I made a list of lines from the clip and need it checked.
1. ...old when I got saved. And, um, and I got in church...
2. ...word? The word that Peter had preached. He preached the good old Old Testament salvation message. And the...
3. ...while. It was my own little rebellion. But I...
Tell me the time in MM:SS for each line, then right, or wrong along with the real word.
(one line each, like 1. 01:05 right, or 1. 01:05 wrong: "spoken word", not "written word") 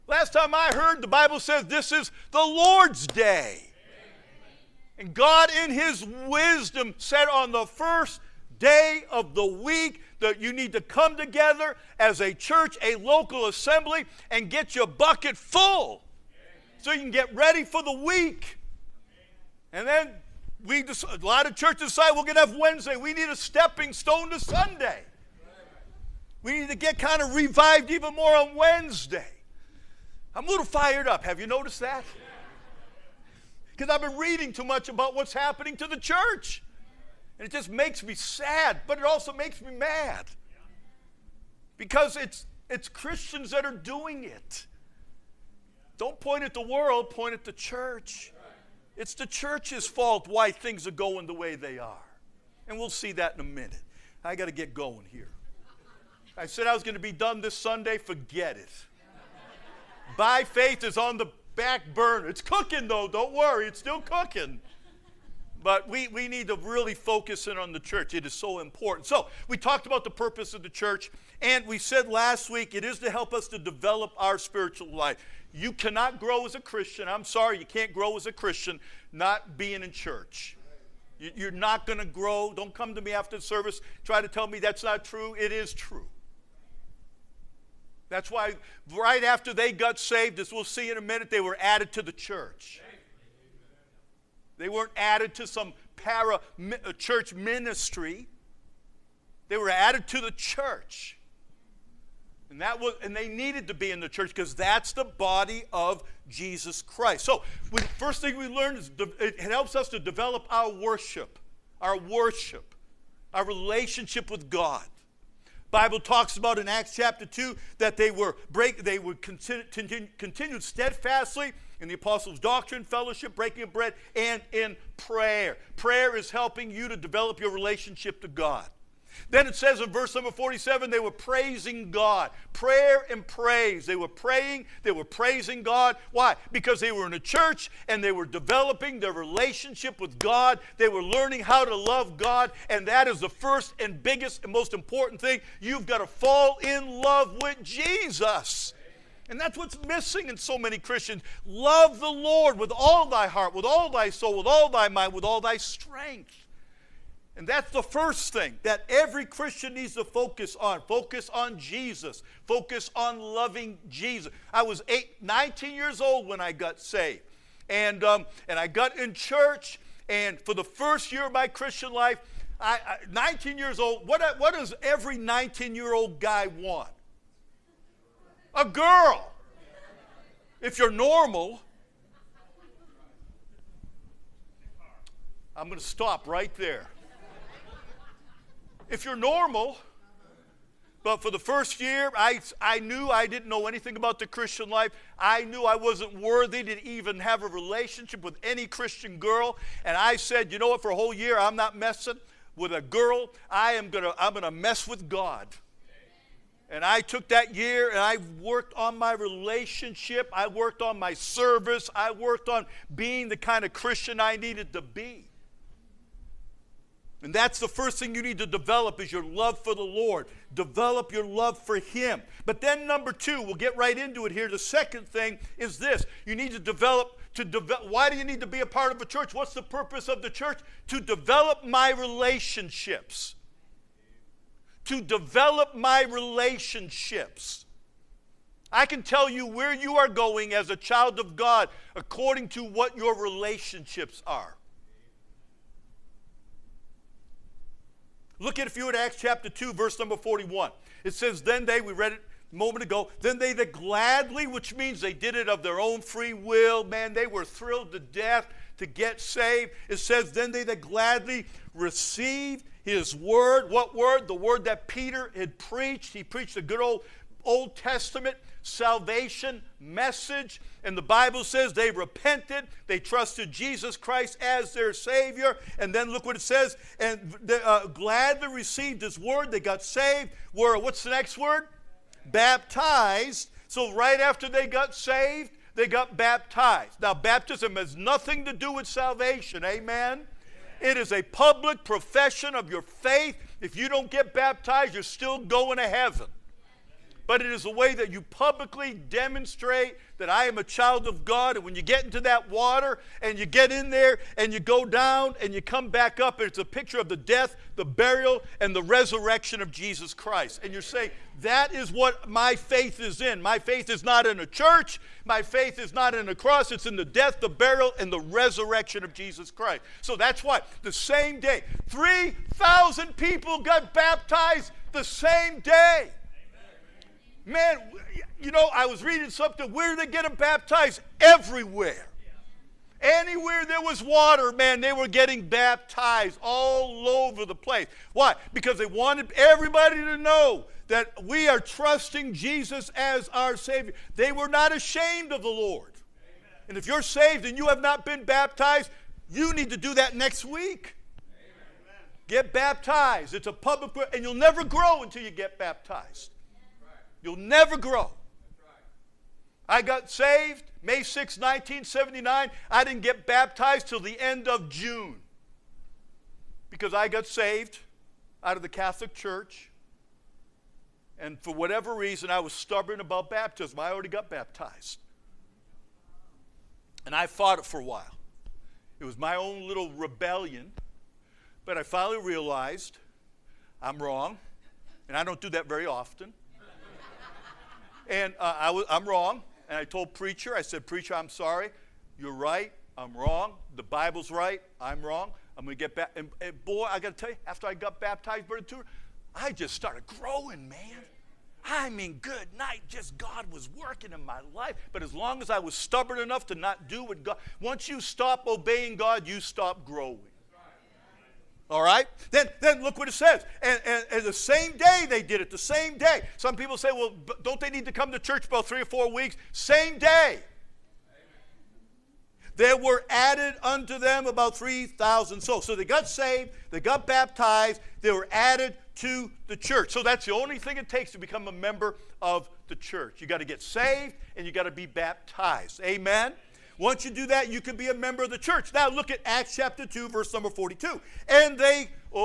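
1. 02:46 right
2. 04:23 right
3. 06:17 right.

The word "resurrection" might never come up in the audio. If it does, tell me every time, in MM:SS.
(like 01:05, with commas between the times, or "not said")
05:08, 05:18.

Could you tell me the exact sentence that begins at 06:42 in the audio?
Just God was working in my life.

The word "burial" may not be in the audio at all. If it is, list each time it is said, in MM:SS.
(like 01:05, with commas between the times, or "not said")
05:07, 05:17.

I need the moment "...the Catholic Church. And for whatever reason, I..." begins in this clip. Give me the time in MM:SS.
06:08.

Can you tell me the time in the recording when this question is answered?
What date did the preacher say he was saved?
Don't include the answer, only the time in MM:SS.
06:00.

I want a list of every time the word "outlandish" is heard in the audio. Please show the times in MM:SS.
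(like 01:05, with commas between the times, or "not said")
not said.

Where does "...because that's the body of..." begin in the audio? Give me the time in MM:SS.
01:44.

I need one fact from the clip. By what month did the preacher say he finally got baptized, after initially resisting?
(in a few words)
June.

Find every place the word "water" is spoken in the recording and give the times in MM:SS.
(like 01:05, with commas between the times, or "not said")
05:02, 05:34.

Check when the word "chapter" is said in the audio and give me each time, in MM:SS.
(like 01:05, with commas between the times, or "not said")
01:56, 04:09, 07:19.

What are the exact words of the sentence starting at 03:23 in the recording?
I am going to I'm going to mess with God.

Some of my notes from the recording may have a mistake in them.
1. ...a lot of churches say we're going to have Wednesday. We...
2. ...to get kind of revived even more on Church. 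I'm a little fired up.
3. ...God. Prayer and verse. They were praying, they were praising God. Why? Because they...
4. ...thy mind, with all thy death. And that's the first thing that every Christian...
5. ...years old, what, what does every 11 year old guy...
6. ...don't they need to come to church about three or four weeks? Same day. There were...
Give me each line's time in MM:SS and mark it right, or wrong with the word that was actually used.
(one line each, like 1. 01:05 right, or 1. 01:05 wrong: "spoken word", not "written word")
1. 00:21 right
2. 00:26 wrong: "Wednesday", not "Church"
3. 02:11 wrong: "praise", not "verse"
4. 02:34 wrong: "strength", not "death"
5. 02:53 wrong: "19", not "11"
6. 06:57 right.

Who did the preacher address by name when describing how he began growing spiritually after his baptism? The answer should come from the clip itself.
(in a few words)
Brother Tudor.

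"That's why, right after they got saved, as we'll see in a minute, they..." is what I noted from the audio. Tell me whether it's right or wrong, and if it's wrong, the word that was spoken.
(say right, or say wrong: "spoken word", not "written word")
right.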